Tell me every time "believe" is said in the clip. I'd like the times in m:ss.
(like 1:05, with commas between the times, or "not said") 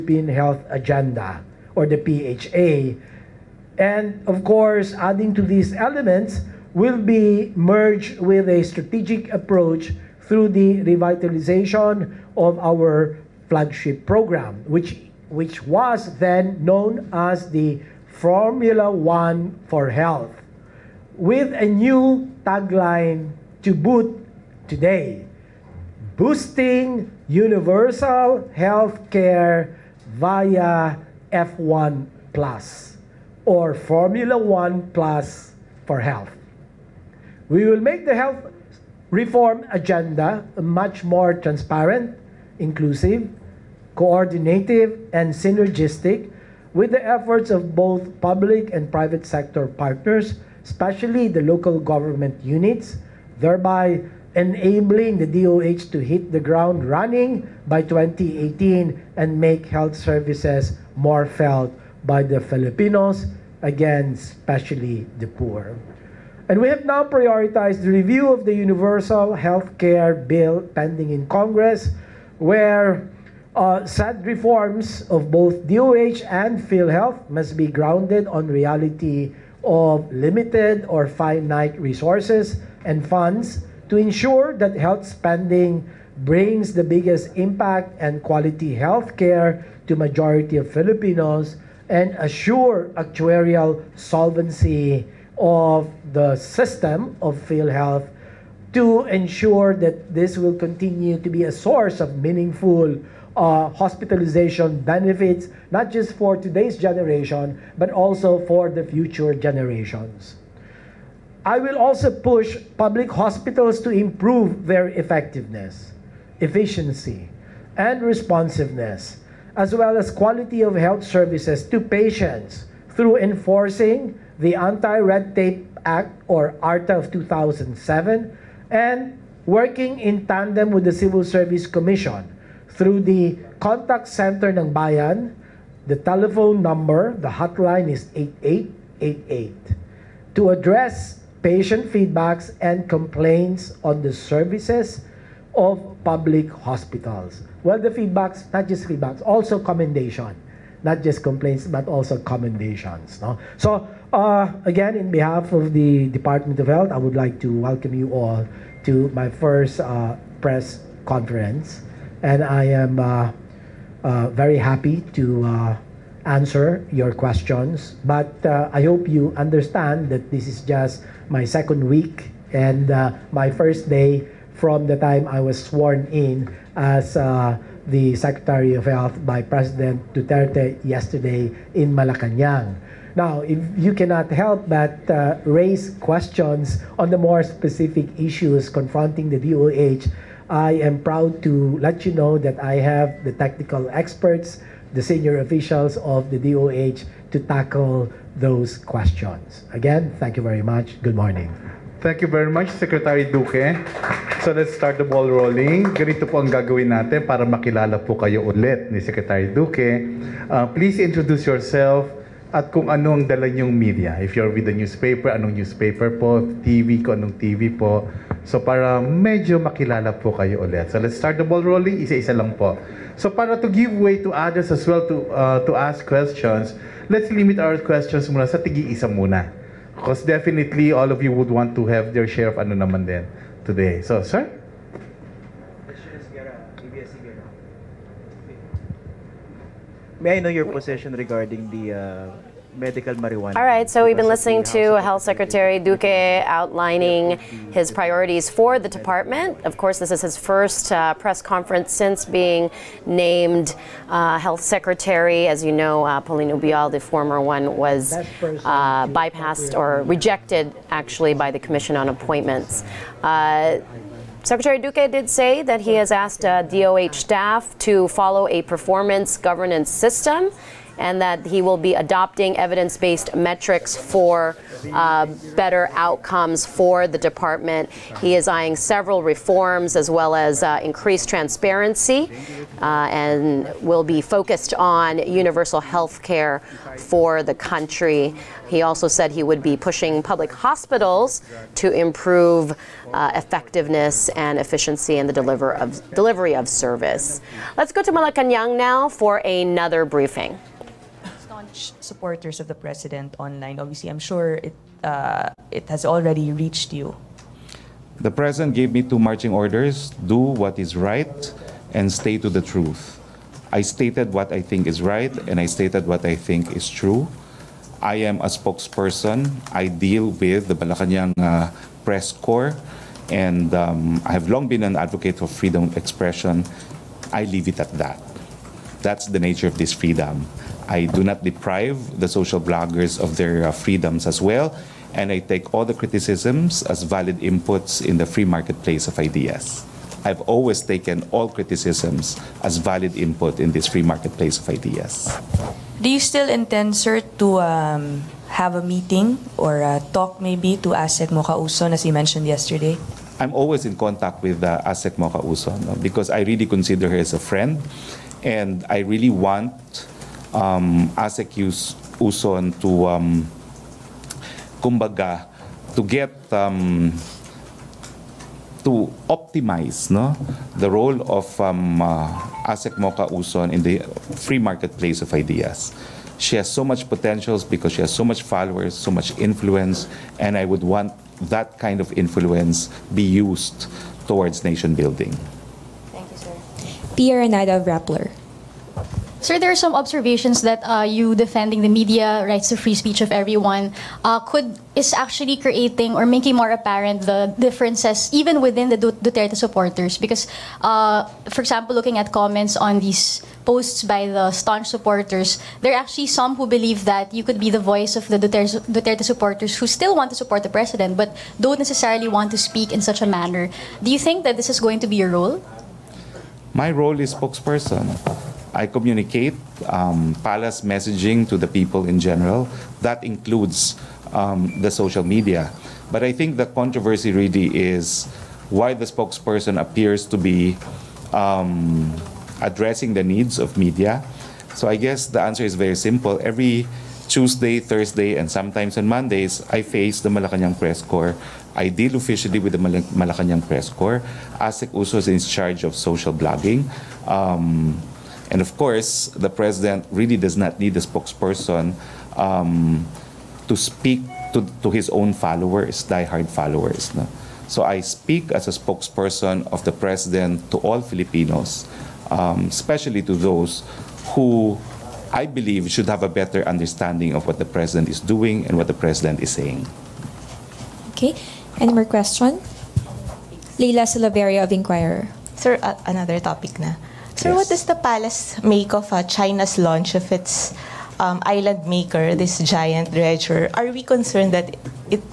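6:46, 7:45.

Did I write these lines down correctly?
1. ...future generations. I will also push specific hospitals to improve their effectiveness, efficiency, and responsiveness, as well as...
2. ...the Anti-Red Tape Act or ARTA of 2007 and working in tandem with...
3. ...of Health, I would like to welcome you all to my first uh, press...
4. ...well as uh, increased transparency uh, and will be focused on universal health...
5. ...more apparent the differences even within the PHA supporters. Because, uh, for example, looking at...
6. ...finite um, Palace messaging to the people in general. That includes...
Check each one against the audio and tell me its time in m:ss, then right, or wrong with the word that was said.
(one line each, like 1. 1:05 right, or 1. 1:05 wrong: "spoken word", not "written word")
1. 1:48 wrong: "public", not "specific"
2. 2:04 right
3. 2:36 right
4. 4:40 right
5. 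6:36 wrong: "Duterte", not "PHA"
6. 6:58 wrong: "communicate", not "finite".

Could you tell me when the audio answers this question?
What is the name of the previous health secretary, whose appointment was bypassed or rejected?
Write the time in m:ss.
4:16.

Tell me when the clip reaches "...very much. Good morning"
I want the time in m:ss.
3:20.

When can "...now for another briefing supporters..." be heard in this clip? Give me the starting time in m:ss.
4:58.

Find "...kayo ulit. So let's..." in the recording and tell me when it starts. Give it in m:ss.
3:40.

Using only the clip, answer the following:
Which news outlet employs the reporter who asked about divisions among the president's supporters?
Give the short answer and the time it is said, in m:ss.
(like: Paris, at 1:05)
Rappler, at 6:27.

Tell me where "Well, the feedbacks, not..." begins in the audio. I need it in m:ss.
2:27.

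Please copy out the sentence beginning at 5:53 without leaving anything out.
I'm always in contact with uh, ASEC Mocha Uson no?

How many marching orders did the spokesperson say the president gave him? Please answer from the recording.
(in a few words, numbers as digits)
2.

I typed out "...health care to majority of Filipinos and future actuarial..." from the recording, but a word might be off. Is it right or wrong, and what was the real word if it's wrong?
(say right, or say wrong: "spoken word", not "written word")
wrong: "assure", not "future".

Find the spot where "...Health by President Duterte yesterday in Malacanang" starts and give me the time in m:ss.
2:58.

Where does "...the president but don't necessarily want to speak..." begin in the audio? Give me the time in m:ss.
6:50.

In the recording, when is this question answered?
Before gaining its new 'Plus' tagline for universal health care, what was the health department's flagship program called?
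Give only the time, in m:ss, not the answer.
0:18.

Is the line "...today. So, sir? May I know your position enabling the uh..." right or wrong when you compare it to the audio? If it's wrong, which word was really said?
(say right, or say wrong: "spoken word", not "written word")
wrong: "regarding", not "enabling".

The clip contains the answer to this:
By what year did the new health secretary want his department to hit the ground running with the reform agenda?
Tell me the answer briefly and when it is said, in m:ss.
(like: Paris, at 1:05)
2018, at 0:57.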